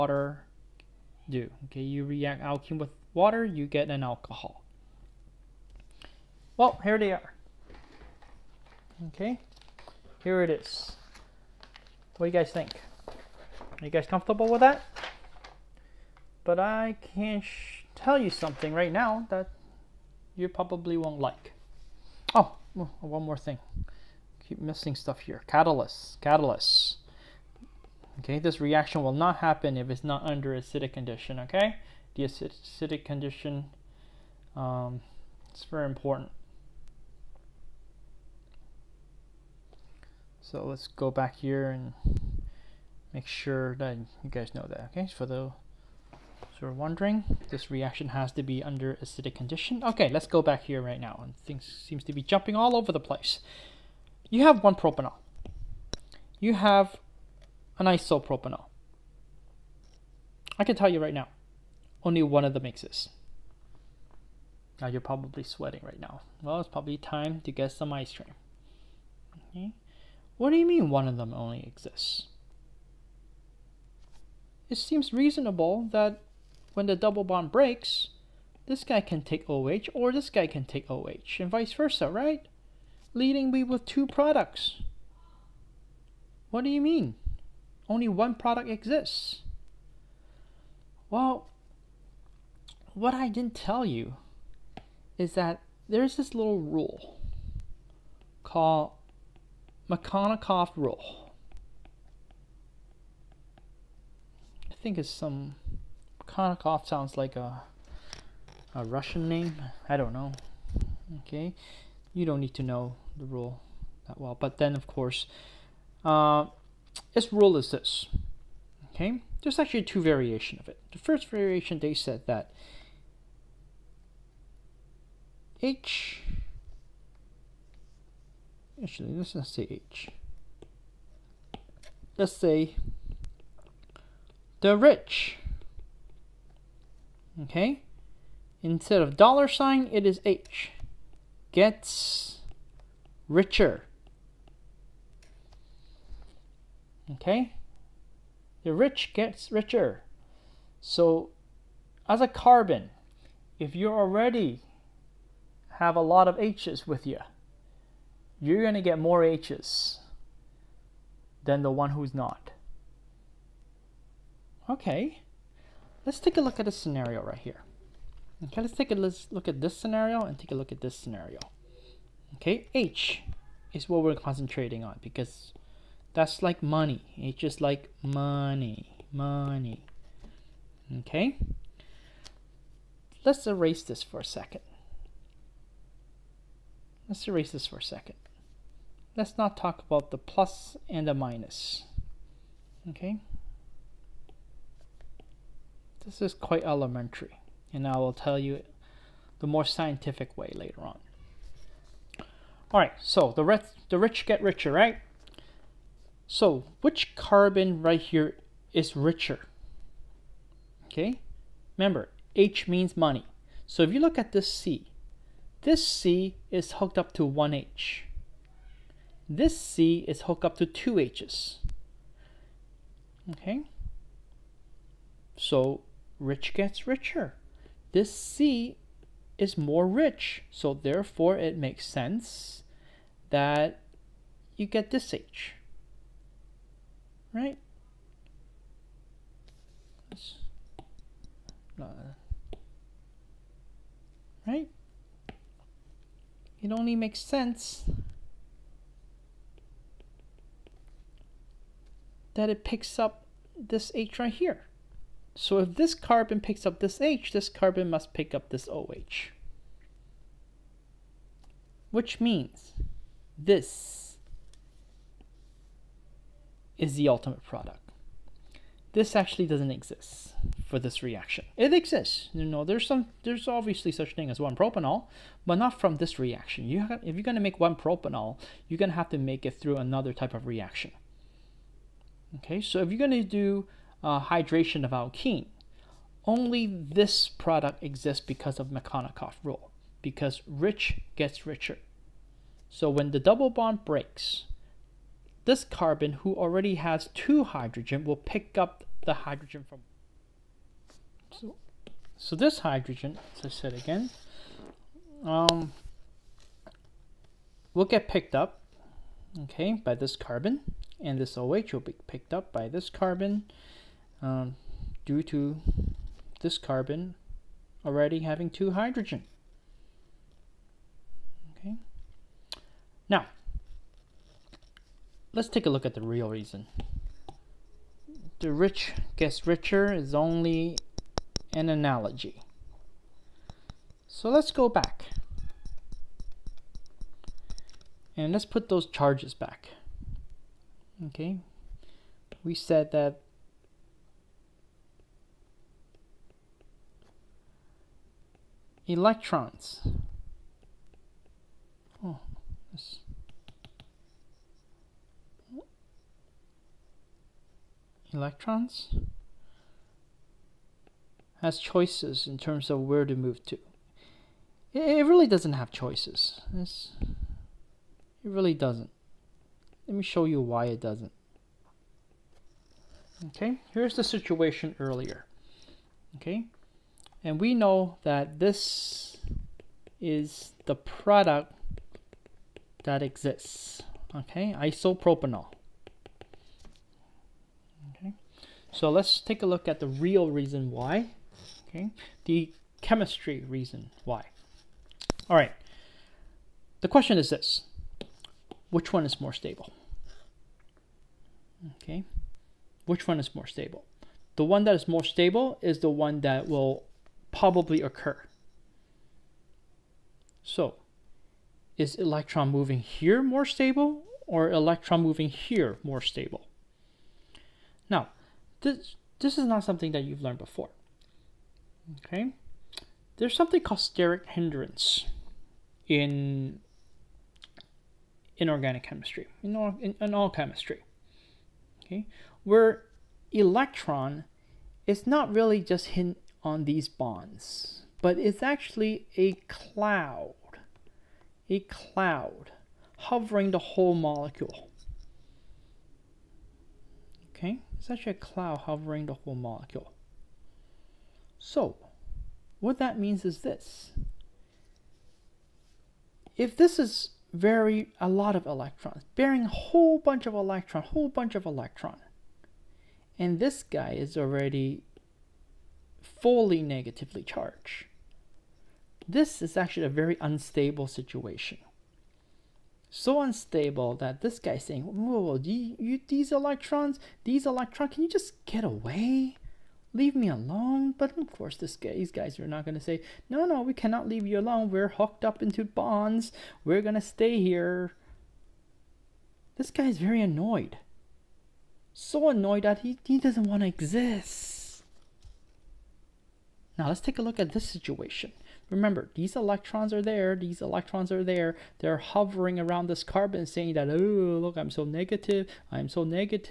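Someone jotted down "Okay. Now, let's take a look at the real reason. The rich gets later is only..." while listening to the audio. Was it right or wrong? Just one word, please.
wrong.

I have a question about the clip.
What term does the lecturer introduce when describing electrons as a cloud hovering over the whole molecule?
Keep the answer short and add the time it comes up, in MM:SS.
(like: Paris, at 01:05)
steric hindrance, at 07:03.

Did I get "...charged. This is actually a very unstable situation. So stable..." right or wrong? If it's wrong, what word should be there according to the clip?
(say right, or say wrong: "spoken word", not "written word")
wrong: "unstable", not "stable".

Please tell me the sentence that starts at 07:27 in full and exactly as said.
Okay, it's actually a cloud hovering the whole molecule.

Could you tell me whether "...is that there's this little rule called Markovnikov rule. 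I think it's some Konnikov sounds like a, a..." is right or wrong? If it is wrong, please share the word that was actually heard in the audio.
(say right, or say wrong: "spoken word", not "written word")
right.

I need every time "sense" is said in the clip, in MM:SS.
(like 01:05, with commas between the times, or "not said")
03:51, 04:07.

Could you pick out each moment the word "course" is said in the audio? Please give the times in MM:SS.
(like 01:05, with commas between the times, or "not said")
01:54, 08:01.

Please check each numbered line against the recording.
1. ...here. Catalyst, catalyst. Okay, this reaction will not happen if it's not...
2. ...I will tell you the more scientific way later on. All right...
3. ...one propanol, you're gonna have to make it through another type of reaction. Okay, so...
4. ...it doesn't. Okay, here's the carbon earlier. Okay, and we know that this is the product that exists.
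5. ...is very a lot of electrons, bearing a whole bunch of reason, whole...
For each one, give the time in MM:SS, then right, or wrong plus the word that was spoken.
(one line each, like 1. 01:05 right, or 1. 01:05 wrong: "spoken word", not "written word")
1. 00:25 right
2. 03:17 right
3. 04:37 right
4. 06:10 wrong: "situation", not "carbon"
5. 07:36 wrong: "electron", not "reason".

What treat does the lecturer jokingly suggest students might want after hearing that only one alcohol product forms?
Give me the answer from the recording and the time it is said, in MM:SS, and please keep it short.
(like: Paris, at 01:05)
ice cream, at 01:07.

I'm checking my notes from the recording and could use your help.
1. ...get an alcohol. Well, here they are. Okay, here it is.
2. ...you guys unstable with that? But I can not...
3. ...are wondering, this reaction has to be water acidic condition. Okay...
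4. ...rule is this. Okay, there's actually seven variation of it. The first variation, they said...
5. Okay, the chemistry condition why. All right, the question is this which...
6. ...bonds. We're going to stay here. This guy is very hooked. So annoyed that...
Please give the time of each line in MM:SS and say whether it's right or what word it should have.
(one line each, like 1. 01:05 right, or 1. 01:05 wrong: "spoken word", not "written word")
1. 00:03 right
2. 00:13 wrong: "comfortable", not "unstable"
3. 00:46 wrong: "under", not "water"
4. 01:57 wrong: "two", not "seven"
5. 06:31 wrong: "reason", not "condition"
6. 08:05 wrong: "annoyed", not "hooked".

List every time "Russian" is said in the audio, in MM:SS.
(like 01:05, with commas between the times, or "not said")
01:48.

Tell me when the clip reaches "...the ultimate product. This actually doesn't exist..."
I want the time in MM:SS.
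04:26.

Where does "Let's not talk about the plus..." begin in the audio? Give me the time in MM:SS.
03:09.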